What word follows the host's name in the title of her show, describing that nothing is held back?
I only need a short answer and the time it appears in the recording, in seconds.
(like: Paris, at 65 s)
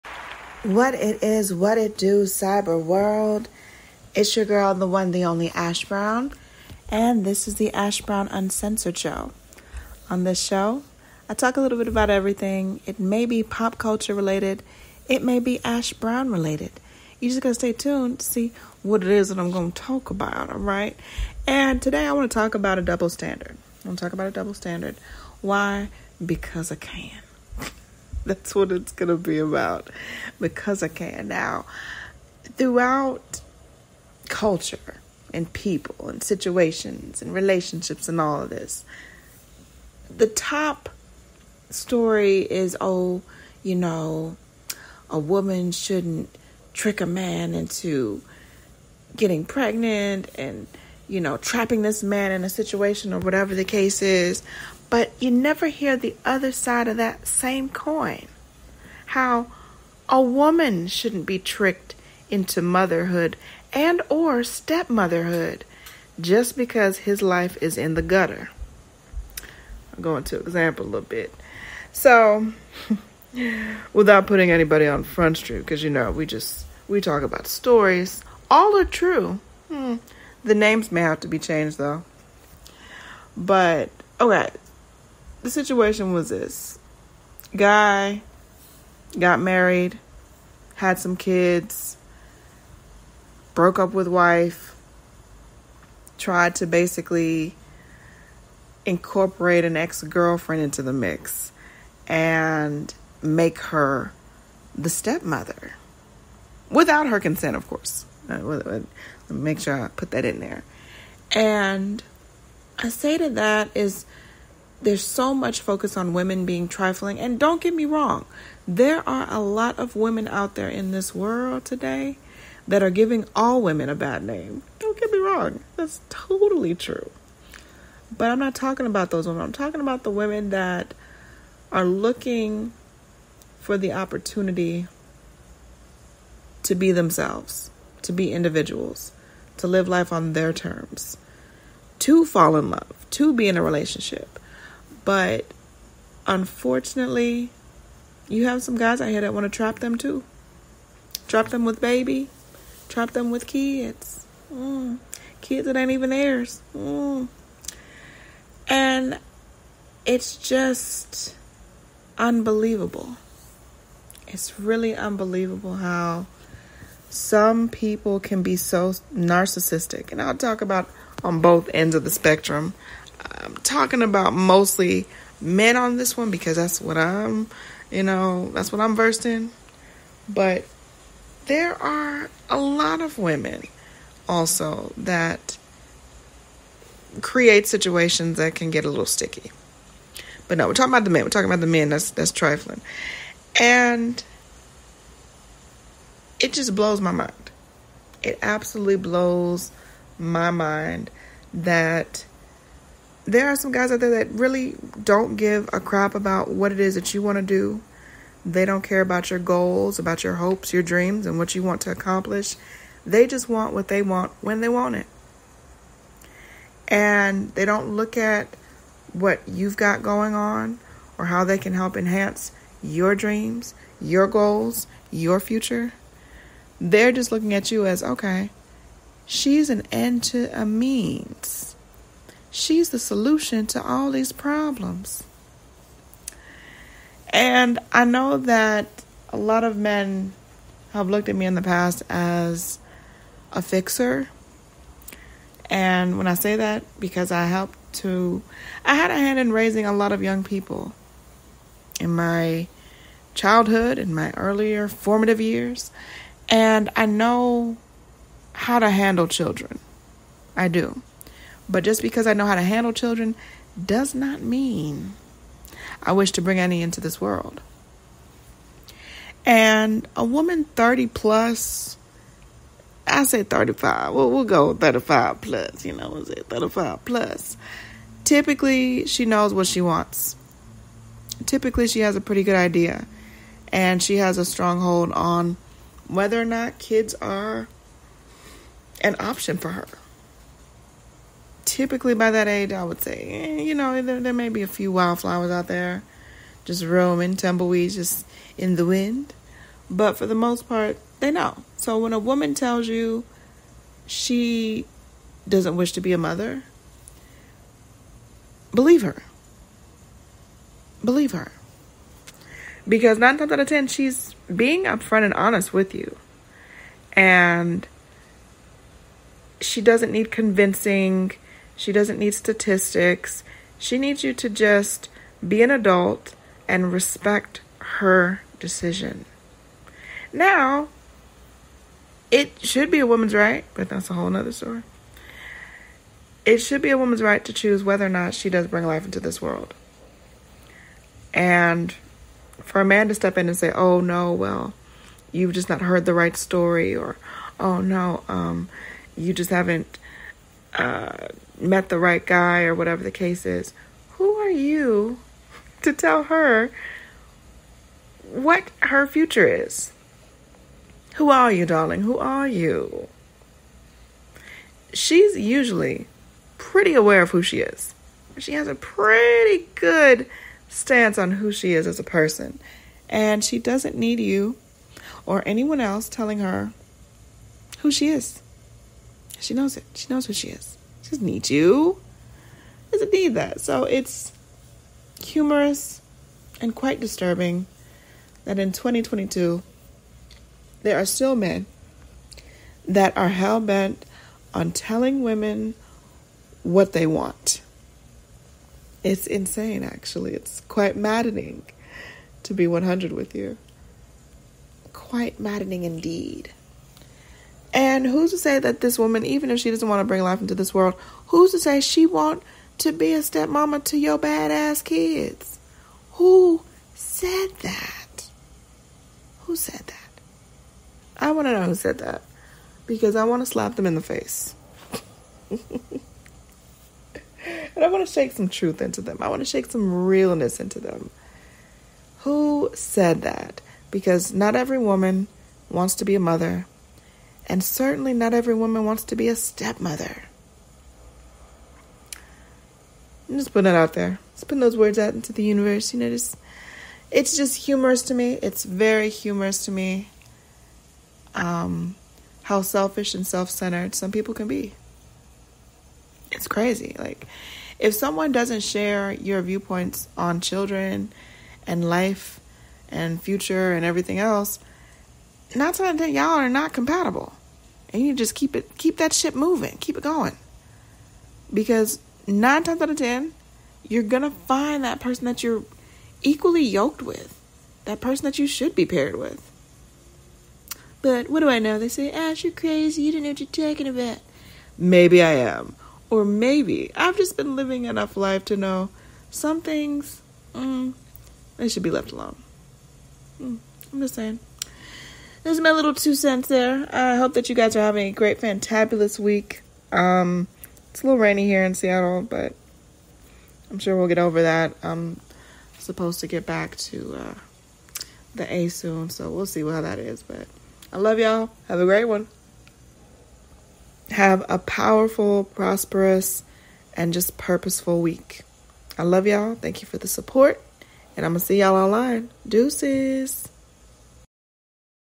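Uncensored, at 8 s.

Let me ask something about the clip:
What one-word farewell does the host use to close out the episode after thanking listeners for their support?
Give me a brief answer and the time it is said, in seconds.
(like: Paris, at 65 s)
Deuces, at 522 s.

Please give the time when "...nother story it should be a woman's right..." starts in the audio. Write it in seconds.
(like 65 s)
334 s.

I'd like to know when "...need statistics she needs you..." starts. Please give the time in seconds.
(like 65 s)
322 s.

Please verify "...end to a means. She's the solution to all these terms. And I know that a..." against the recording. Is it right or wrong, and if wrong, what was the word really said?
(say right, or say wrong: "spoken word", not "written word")
wrong: "problems", not "terms".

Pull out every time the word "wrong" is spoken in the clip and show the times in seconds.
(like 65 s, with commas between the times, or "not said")
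117 s, 125 s.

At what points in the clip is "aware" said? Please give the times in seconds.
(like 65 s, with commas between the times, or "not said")
366 s.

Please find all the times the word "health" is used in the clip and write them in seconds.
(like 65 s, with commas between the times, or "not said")
not said.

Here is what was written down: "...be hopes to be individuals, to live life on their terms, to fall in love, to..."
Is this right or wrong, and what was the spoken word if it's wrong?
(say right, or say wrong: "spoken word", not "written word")
wrong: "themselves", not "hopes".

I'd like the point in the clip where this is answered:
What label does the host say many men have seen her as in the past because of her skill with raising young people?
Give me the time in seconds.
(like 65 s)
243 s.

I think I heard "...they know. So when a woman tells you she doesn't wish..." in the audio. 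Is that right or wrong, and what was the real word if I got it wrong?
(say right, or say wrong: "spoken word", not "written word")
right.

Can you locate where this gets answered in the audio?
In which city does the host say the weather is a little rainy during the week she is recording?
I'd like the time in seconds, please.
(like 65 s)
501 s.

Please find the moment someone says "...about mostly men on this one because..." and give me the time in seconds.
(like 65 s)
174 s.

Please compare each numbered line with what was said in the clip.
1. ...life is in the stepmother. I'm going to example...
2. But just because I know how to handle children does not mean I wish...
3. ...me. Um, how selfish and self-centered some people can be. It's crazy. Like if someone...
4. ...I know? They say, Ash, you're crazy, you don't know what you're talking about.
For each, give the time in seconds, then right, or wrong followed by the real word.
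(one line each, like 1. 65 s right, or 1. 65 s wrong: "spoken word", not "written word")
1. 67 s wrong: "gutter", not "stepmother"
2. 261 s right
3. 449 s right
4. 481 s right.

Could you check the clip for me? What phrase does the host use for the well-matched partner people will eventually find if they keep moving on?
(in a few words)
Equally yoked.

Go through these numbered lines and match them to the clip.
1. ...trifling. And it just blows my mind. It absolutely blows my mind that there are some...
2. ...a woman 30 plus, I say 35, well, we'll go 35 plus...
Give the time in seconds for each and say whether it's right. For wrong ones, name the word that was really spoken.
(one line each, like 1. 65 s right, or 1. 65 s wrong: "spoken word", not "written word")
1. 192 s right
2. 270 s right.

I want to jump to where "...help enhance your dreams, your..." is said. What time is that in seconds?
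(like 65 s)
221 s.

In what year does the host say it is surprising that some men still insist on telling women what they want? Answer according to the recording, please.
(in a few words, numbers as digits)
2022.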